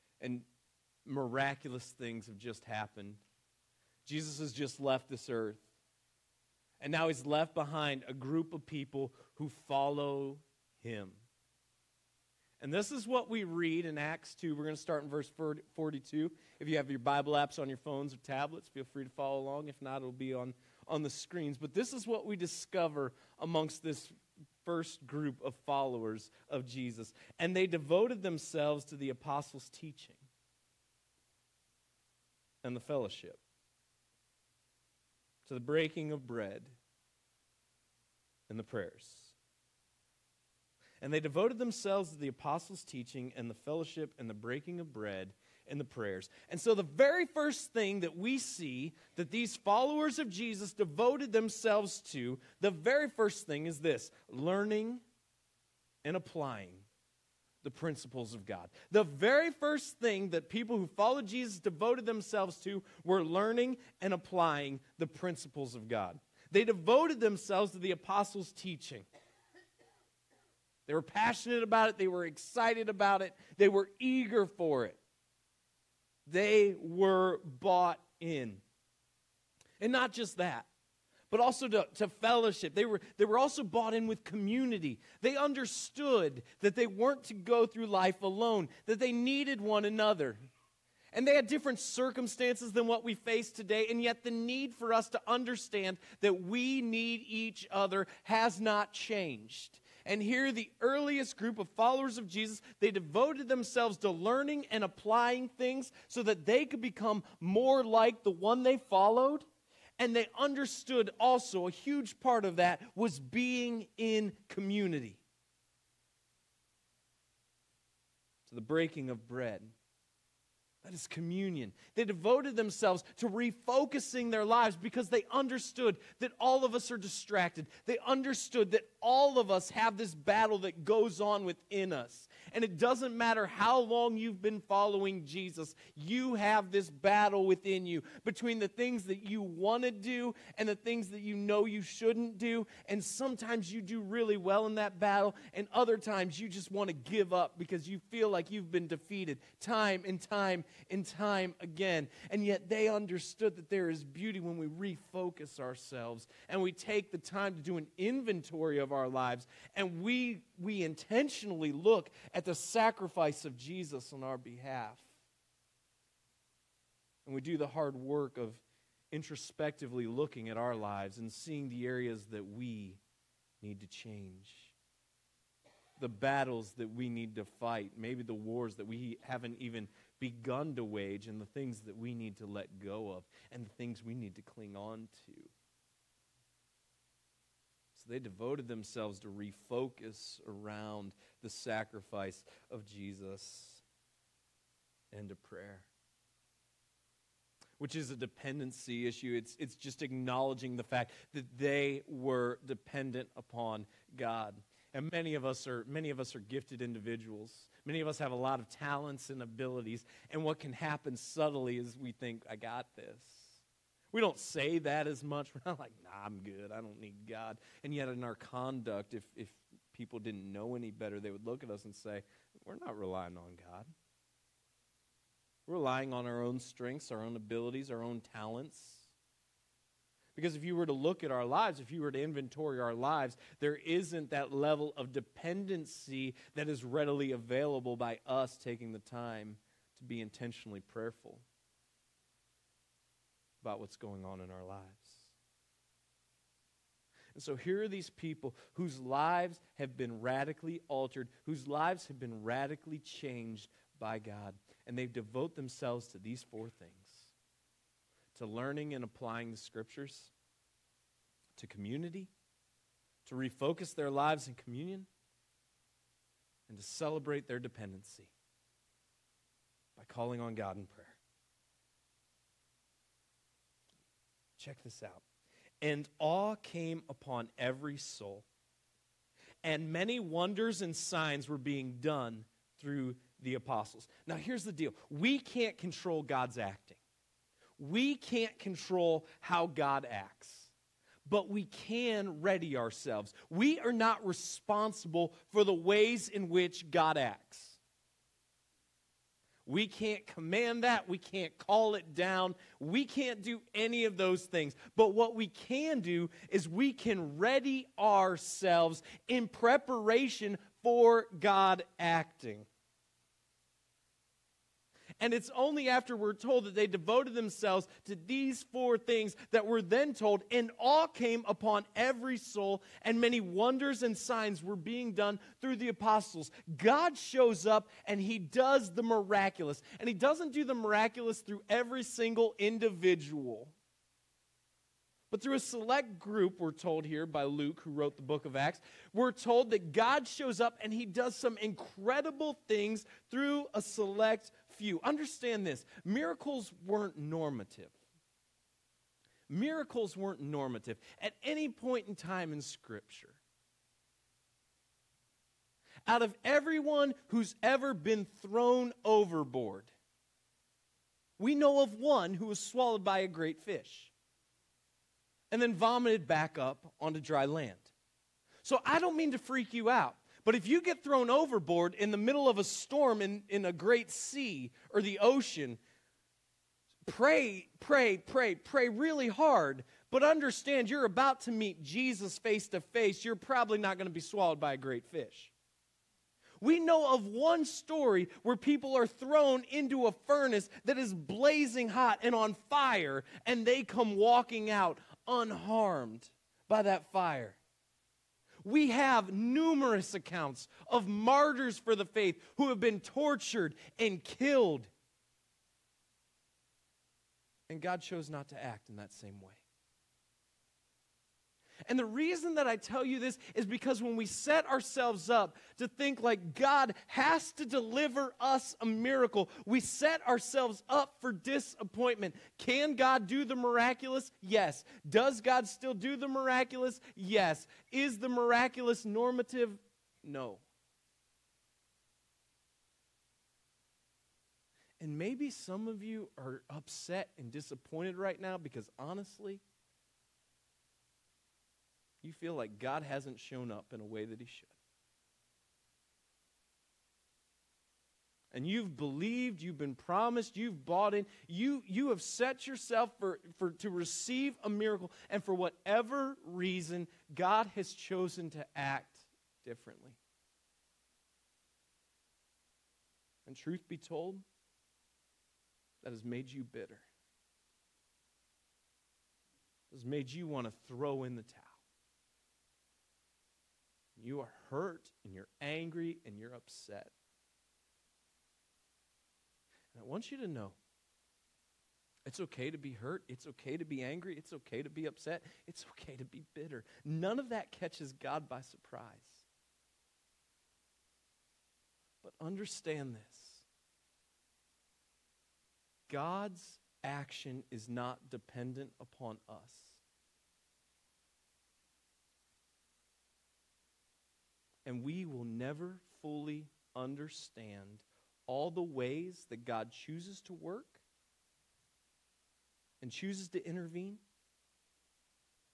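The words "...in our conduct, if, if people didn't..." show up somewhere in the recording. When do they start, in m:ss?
3:38.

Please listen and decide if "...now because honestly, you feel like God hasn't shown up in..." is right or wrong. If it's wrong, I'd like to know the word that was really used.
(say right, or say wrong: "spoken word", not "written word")
right.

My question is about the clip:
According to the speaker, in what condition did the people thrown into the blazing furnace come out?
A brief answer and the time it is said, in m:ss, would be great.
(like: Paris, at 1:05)
Unharmed, at 6:35.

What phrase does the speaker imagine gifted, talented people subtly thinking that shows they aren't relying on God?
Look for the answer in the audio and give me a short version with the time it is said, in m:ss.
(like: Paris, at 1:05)
I got this, at 3:32.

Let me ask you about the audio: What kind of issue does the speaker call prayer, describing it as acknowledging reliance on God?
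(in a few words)
A dependency issue.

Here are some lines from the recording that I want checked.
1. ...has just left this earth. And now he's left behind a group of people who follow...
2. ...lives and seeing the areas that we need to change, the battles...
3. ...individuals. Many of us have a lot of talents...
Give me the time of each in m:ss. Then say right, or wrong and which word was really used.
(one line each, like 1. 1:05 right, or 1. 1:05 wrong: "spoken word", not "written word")
1. 0:04 right
2. 2:50 right
3. 3:26 right.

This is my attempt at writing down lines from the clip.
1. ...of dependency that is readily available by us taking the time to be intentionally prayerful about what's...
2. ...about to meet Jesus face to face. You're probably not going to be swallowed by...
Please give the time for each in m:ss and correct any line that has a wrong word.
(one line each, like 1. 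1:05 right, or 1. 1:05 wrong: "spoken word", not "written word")
1. 3:54 right
2. 6:21 right.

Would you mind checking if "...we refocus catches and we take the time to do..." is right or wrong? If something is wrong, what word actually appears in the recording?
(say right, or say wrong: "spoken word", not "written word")
wrong: "ourselves", not "catches".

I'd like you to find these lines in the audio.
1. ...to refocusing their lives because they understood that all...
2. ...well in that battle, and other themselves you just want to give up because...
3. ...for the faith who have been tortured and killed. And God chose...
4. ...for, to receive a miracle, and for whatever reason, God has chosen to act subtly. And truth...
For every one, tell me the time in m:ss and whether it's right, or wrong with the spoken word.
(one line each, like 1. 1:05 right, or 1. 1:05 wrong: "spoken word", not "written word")
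1. 2:03 right
2. 2:24 wrong: "times", not "themselves"
3. 6:41 right
4. 7:33 wrong: "differently", not "subtly".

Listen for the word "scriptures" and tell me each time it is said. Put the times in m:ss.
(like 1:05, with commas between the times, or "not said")
4:19, 5:52.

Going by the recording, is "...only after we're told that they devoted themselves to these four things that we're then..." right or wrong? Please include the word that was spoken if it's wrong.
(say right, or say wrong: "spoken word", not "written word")
right.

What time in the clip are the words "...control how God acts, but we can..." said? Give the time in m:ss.
4:48.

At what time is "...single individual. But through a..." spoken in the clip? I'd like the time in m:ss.
5:32.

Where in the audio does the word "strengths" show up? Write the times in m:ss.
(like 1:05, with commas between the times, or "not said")
3:46.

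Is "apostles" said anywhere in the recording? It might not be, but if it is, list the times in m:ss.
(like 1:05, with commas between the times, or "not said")
0:29, 0:42, 1:07, 4:43, 5:25.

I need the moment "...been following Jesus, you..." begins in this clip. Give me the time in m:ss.
2:14.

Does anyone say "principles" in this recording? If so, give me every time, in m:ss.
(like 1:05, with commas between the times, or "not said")
0:57, 1:05.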